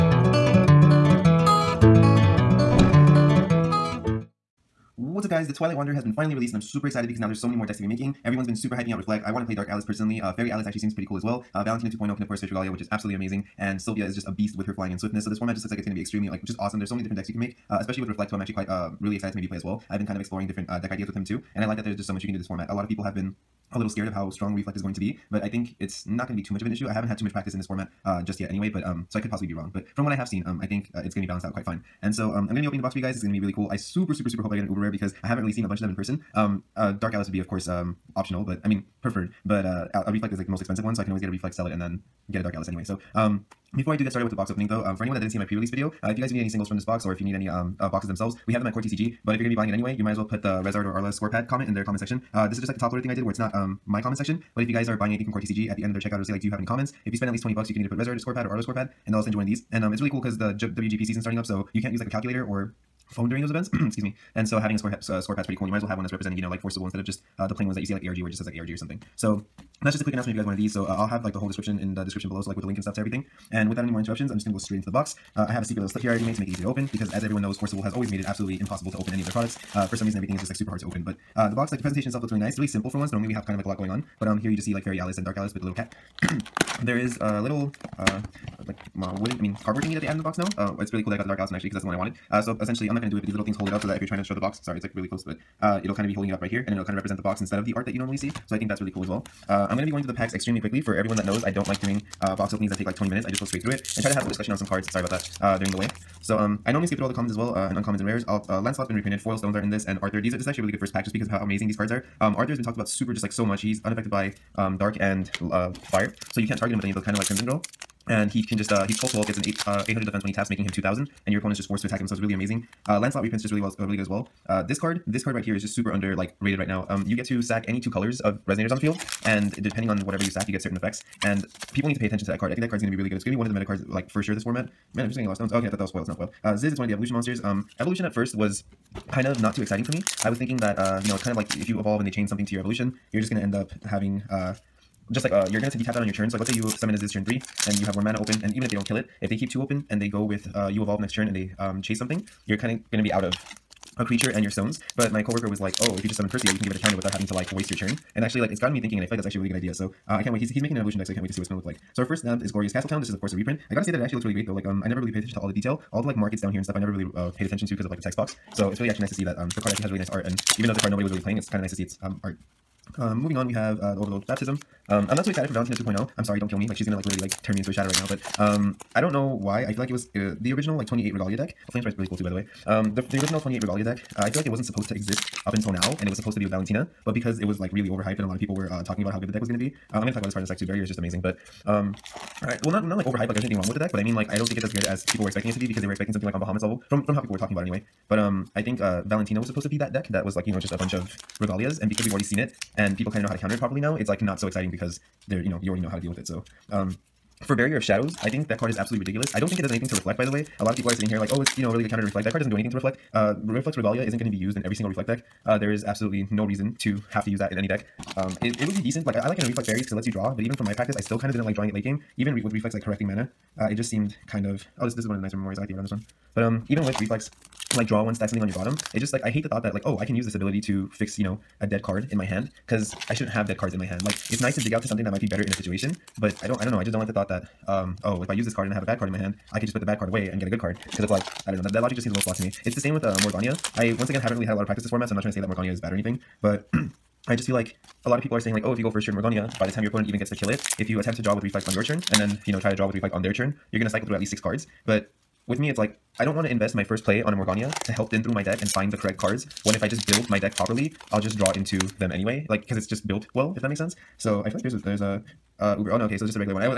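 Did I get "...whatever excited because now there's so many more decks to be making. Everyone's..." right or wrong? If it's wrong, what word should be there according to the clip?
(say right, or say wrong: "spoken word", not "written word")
wrong: "super", not "whatever".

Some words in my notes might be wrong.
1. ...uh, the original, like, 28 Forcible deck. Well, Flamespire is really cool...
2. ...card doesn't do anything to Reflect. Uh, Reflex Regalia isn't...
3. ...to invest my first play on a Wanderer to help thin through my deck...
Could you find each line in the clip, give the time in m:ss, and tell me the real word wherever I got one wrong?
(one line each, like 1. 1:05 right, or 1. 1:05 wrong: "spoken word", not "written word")
1. 3:00 wrong: "Regalia", not "Forcible"
2. 3:32 right
3. 4:16 wrong: "Morgania", not "Wanderer".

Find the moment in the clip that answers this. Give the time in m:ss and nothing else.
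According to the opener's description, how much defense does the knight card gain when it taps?
1:59.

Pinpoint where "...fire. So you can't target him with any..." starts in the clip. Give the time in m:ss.
1:55.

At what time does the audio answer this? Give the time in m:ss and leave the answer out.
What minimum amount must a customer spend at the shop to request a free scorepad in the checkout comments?
0:57.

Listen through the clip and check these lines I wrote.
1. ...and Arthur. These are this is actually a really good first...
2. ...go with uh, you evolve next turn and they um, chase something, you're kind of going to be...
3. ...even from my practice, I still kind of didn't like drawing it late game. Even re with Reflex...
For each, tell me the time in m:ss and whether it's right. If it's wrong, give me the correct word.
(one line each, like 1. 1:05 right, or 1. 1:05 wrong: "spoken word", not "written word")
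1. 1:49 right
2. 2:30 right
3. 3:40 right.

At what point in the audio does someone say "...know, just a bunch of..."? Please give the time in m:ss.
3:20.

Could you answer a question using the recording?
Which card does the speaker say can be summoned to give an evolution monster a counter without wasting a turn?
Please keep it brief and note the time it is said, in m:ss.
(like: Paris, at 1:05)
Percy, at 2:36.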